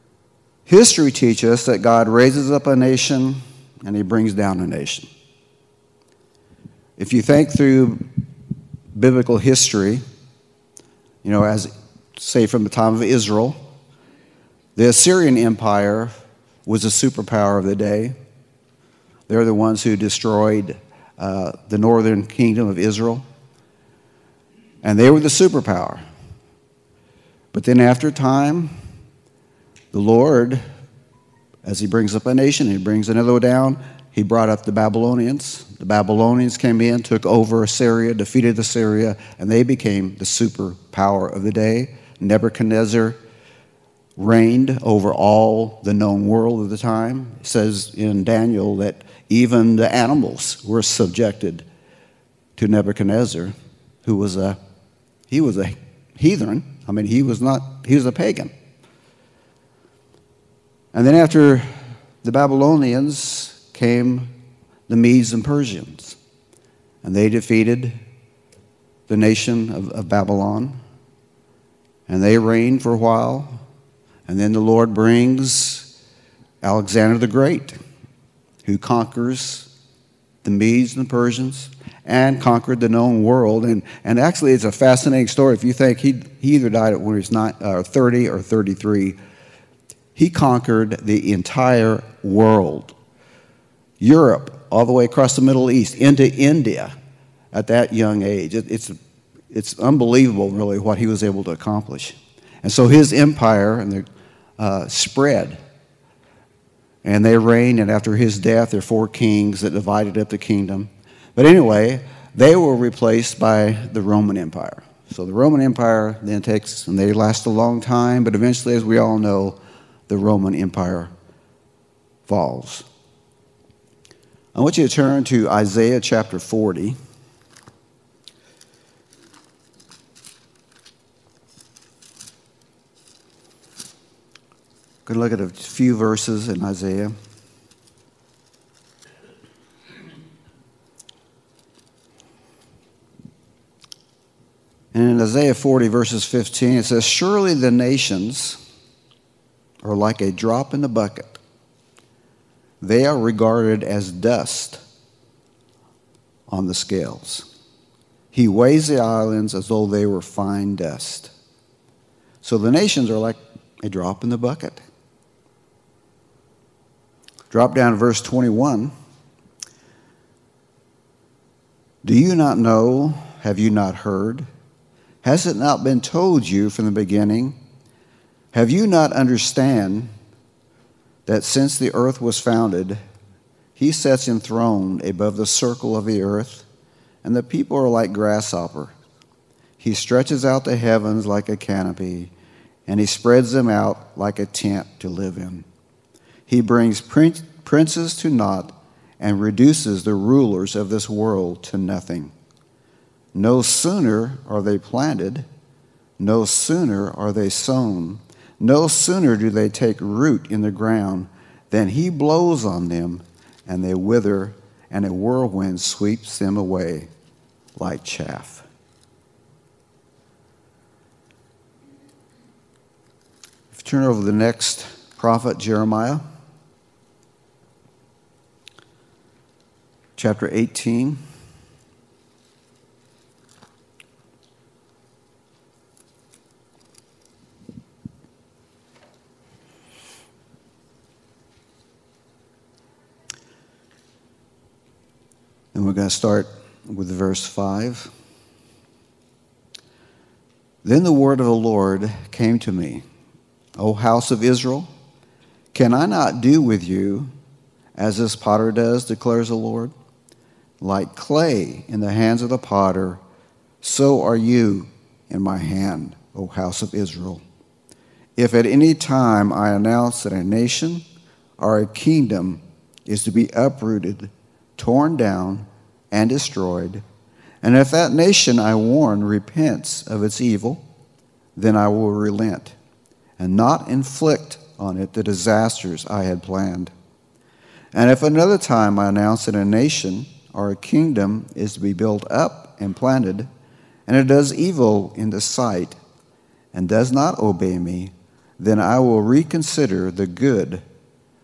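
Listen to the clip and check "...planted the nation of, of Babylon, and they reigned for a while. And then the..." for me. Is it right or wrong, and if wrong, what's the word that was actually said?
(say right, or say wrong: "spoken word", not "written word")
wrong: "defeated", not "planted".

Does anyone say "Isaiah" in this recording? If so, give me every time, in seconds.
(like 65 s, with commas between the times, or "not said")
125 s, 136 s, 145 s.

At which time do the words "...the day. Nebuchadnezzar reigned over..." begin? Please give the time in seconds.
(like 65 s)
41 s.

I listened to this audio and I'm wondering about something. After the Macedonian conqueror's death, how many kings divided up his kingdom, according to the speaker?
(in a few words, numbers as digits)
4.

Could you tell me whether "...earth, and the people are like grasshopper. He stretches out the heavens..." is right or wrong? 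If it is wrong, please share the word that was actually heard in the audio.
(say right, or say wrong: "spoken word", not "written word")
right.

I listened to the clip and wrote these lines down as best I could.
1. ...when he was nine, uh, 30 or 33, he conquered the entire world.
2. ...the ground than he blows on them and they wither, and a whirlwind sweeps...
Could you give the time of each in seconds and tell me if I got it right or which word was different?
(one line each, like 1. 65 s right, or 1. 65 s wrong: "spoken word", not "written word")
1. 86 s right
2. 210 s right.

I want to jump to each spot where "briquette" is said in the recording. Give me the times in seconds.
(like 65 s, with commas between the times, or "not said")
not said.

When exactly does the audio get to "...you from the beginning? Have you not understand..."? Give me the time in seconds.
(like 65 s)
176 s.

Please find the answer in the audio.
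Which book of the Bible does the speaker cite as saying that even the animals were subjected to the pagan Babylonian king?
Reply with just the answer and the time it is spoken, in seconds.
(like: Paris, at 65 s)
Daniel, at 48 s.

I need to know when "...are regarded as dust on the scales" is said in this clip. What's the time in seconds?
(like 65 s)
153 s.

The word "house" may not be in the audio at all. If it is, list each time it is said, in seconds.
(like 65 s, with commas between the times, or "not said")
253 s, 266 s.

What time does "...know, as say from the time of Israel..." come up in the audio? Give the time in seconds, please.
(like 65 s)
11 s.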